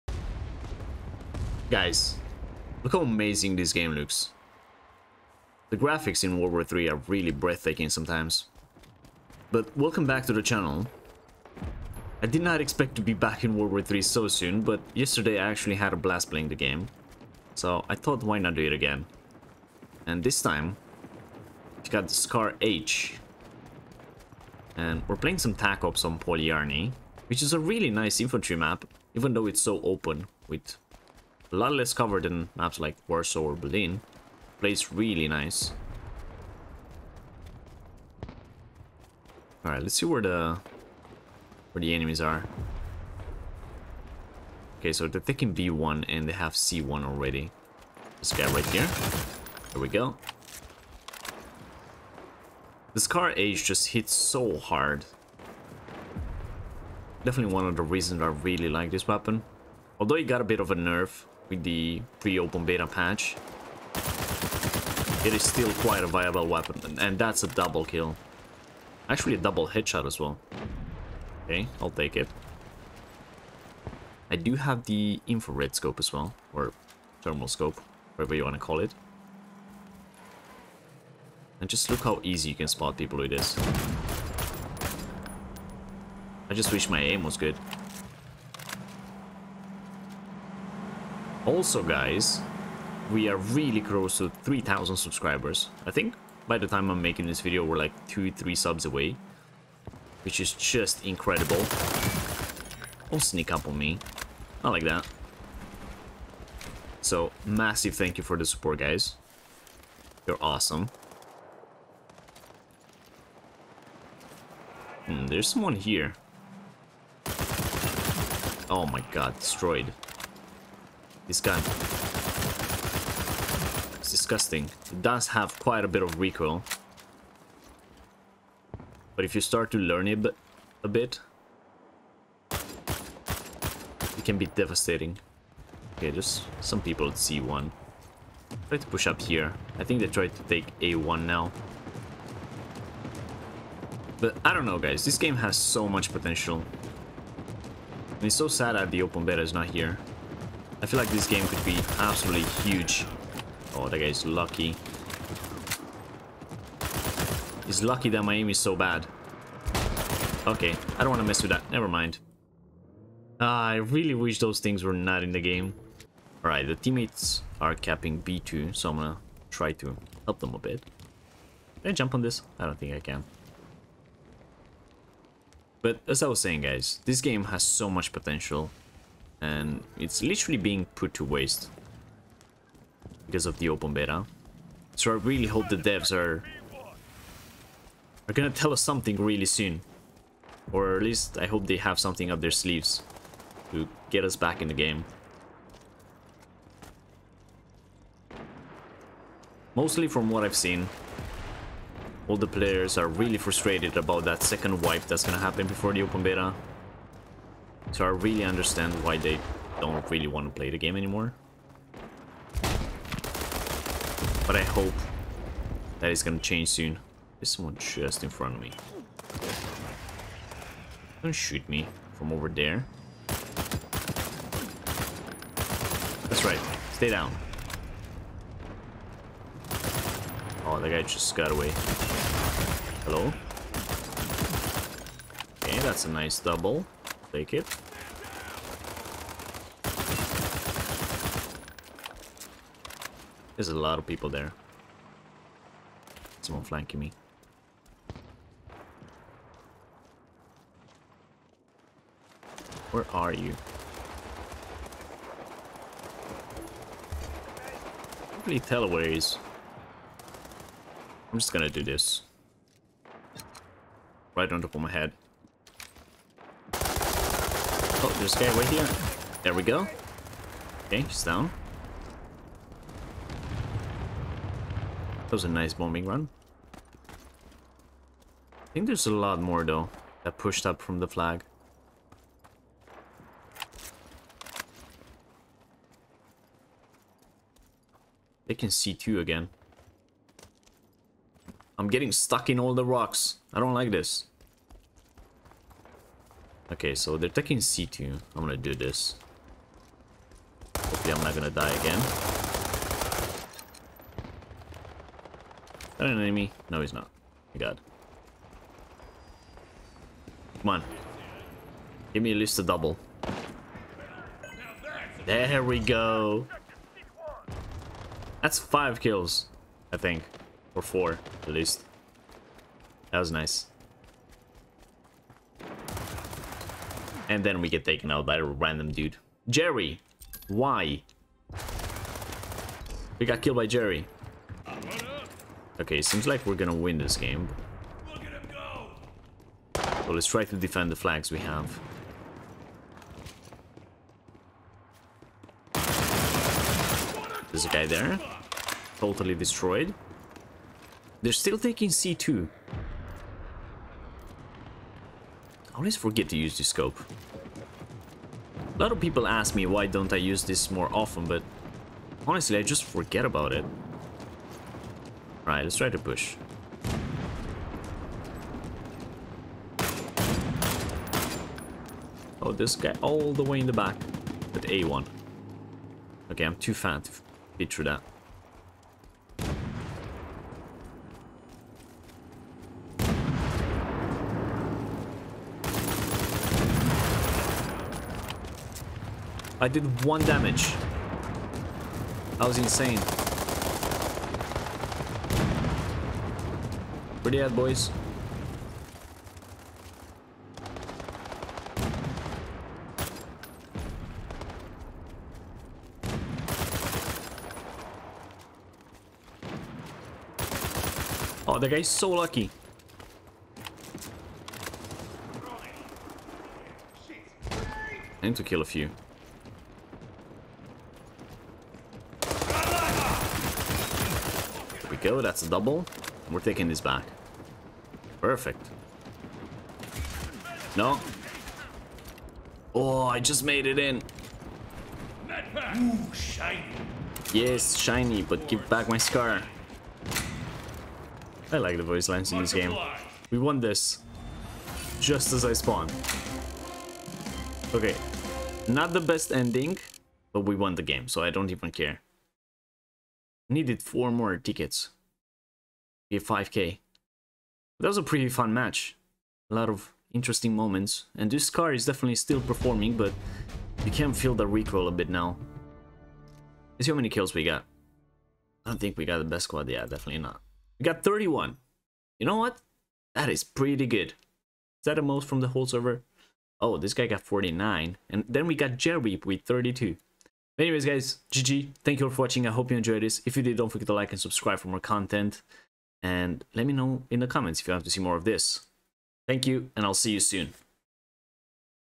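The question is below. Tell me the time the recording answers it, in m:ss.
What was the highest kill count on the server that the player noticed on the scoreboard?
7:57.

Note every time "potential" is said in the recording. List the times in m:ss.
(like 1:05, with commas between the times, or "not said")
2:26, 2:58.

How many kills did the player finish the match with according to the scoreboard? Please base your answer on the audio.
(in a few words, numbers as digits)
31.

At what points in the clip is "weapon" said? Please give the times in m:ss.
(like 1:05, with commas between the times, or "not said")
0:59, 1:06.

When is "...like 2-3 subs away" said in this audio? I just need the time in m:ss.
1:37.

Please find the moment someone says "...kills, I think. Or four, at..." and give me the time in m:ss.
5:19.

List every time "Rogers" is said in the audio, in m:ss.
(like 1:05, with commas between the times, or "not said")
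not said.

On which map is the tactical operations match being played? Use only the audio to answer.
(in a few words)
Polyarny.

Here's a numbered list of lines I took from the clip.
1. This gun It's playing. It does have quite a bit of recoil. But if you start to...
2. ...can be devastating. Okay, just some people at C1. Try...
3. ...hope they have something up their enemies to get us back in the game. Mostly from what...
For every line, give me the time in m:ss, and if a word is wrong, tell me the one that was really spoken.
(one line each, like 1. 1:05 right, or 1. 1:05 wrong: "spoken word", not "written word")
1. 2:01 wrong: "disgusting", not "playing"
2. 2:14 right
3. 3:11 wrong: "sleeves", not "enemies".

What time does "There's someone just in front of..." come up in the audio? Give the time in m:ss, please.
3:37.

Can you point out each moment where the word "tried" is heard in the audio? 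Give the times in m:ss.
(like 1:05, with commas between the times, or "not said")
2:20.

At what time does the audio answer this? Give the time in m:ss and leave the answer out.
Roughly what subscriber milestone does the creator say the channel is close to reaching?
1:34.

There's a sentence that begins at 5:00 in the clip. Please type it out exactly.
Hopefully I'm not gonna die again.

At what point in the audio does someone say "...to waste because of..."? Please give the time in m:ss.
3:01.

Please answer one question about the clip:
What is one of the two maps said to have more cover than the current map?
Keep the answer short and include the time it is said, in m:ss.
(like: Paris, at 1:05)
Warsaw, at 0:33.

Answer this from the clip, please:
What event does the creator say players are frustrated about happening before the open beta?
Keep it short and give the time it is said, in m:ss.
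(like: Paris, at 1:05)
second wipe, at 3:24.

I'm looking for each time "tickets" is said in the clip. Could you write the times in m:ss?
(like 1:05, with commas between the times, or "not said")
7:34.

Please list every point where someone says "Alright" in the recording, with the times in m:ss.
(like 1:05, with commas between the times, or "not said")
0:39, 2:46, 6:05.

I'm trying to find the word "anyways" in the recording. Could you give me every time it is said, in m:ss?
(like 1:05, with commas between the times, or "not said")
8:00.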